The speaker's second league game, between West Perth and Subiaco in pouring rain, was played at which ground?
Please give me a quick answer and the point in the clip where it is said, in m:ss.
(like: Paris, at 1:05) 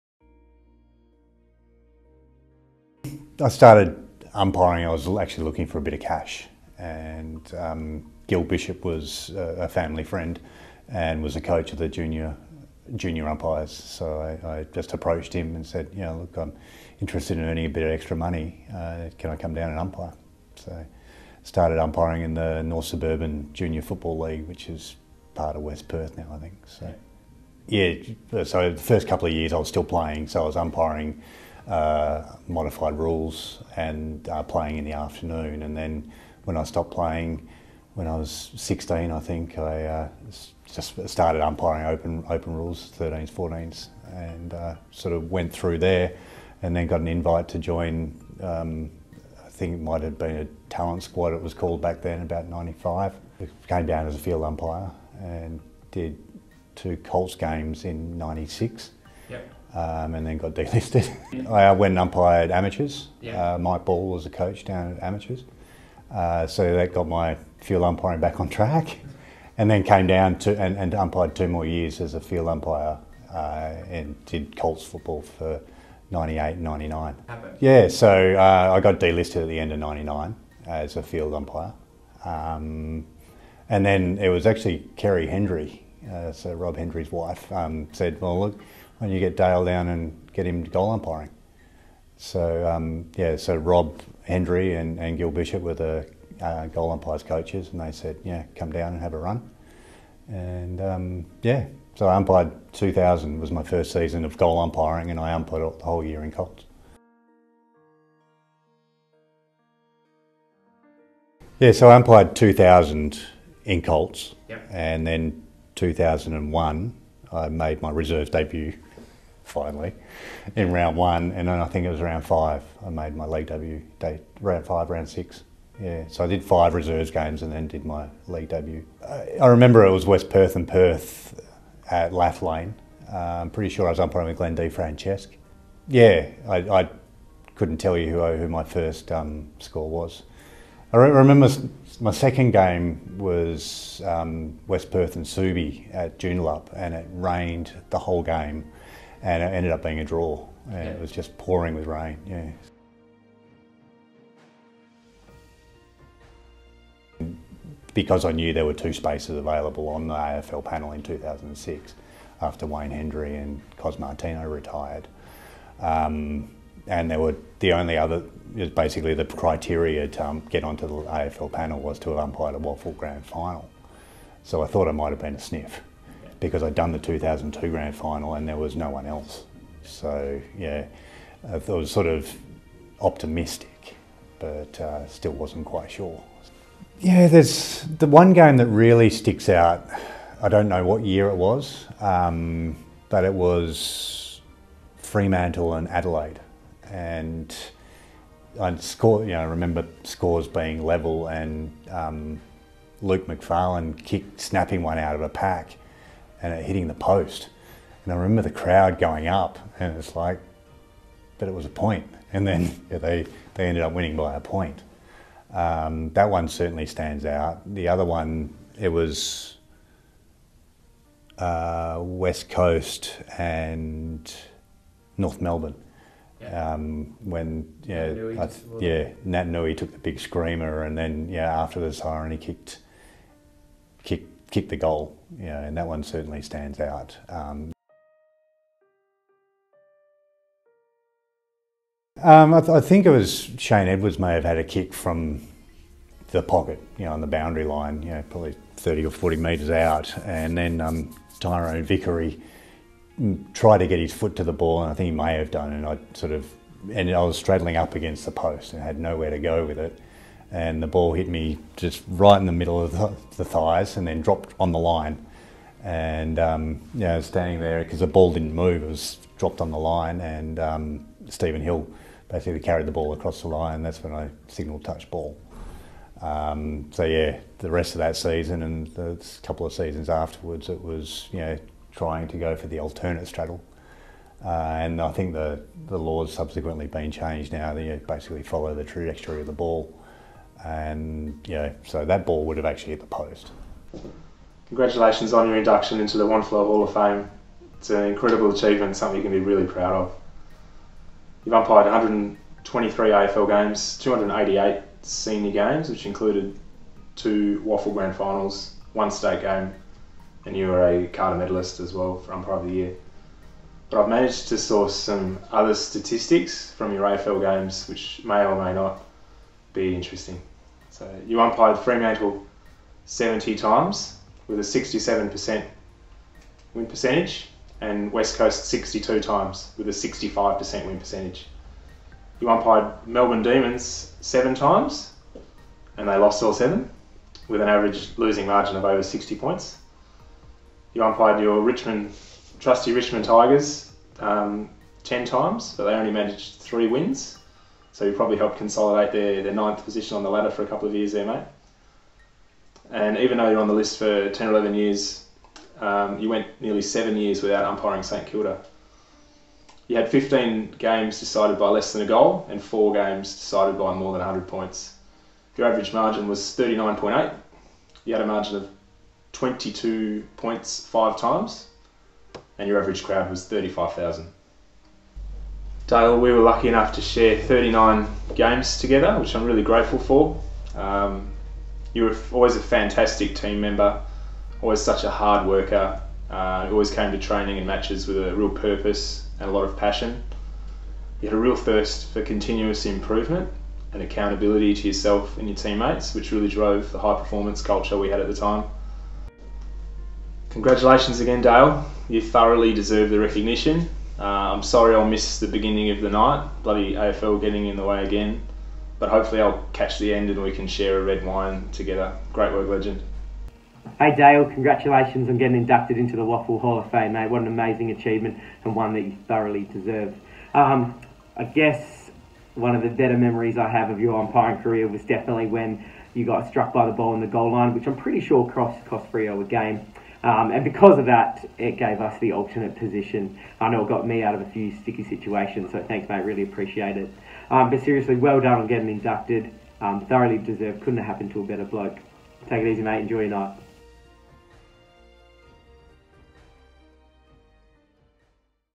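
Joondalup, at 2:26.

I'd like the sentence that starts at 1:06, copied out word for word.
Uh, so that got my field umpiring back on track.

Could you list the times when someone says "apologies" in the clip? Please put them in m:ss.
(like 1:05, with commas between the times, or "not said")
not said.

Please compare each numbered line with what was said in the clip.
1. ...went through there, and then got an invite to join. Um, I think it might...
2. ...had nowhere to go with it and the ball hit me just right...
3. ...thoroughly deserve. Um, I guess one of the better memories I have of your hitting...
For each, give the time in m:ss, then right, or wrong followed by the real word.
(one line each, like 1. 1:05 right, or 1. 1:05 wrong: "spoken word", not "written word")
1. 0:45 right
2. 4:18 right
3. 6:59 wrong: "umpiring", not "hitting".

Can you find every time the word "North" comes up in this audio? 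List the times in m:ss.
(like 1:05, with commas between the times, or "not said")
0:22, 3:45.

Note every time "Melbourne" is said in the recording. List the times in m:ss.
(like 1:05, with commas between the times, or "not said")
3:45, 5:33.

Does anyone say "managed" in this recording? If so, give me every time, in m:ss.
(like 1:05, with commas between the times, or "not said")
5:14, 5:46.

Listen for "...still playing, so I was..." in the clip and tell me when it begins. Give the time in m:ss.
0:29.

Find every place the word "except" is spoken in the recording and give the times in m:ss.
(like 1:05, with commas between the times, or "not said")
not said.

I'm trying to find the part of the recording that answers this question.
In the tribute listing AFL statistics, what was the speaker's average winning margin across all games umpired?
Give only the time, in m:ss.
6:06.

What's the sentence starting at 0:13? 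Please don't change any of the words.
So I, I, just approached him and said, you know, look, I'm interested in earning a bit of extra money.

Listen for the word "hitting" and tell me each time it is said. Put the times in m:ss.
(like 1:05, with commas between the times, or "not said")
3:26.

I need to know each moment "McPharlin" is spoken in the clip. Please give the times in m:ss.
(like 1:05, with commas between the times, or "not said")
3:23.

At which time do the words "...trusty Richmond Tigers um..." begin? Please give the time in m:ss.
5:42.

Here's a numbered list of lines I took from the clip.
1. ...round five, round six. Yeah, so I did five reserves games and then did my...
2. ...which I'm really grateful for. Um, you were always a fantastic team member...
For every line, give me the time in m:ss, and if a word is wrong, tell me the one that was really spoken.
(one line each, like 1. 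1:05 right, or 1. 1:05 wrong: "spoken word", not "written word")
1. 2:04 right
2. 6:19 right.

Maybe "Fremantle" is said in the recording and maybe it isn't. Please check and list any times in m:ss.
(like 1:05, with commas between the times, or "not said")
3:14, 5:21.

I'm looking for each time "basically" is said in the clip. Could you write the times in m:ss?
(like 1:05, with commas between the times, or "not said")
2:48, 4:32, 4:48.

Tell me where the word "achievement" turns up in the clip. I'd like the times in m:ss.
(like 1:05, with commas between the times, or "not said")
4:58, 6:57.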